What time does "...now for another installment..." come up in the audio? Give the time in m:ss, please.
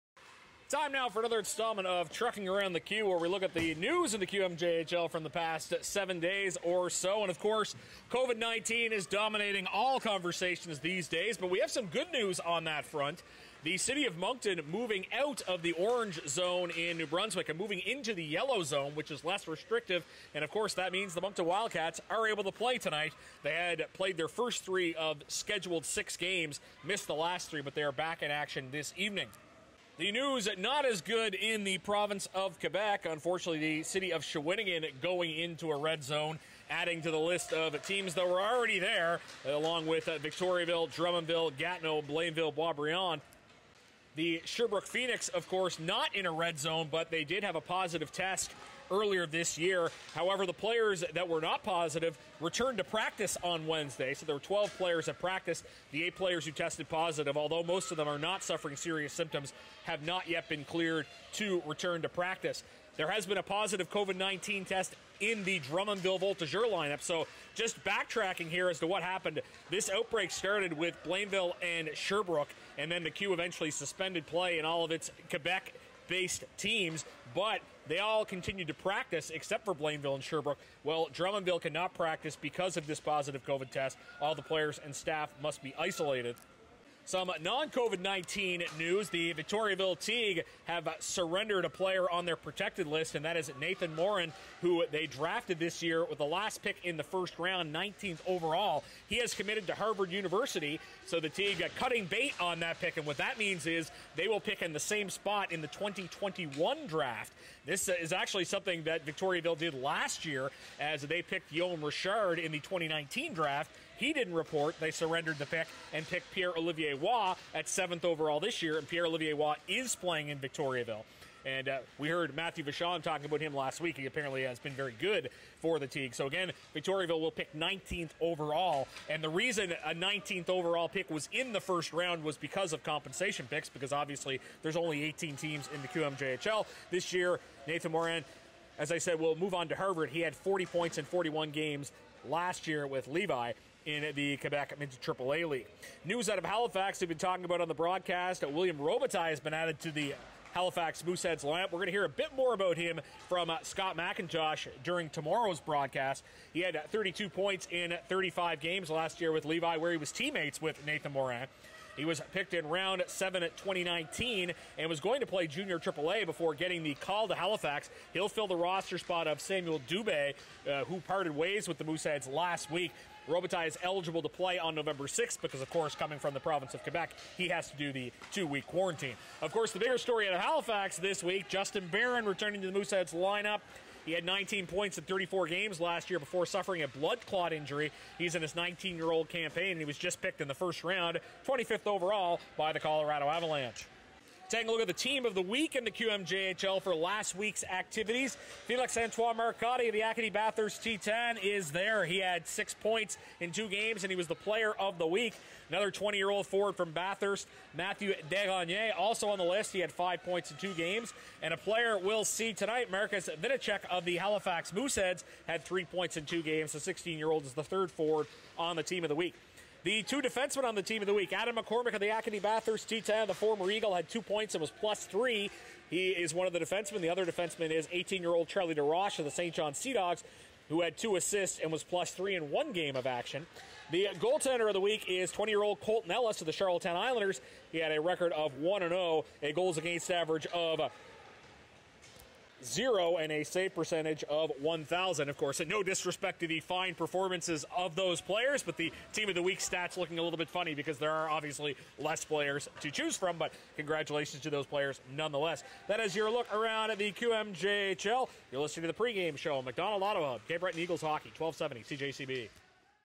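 0:00.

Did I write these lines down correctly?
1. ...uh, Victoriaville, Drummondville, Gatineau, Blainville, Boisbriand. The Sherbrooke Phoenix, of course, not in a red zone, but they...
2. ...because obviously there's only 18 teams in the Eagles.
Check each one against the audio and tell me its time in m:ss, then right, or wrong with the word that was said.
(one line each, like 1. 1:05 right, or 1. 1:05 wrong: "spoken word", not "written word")
1. 0:40 right
2. 2:13 wrong: "QMJHL", not "Eagles".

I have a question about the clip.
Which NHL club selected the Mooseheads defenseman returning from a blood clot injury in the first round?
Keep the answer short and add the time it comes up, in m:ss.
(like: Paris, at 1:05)
Colorado Avalanche, at 3:12.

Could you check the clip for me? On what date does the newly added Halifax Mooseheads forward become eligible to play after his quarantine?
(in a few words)
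November 6th.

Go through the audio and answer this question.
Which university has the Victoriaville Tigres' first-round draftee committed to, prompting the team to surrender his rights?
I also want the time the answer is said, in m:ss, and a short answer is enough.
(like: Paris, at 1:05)
Harvard University, at 1:39.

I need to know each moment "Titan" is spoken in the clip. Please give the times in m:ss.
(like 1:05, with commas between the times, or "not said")
3:20, 3:42.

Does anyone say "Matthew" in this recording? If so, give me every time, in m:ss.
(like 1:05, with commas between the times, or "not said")
2:02, 3:27.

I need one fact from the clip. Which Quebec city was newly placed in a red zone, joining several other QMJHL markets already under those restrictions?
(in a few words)
Shawinigan.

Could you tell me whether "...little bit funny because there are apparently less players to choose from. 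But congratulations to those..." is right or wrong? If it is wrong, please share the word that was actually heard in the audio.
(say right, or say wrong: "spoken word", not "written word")
wrong: "obviously", not "apparently".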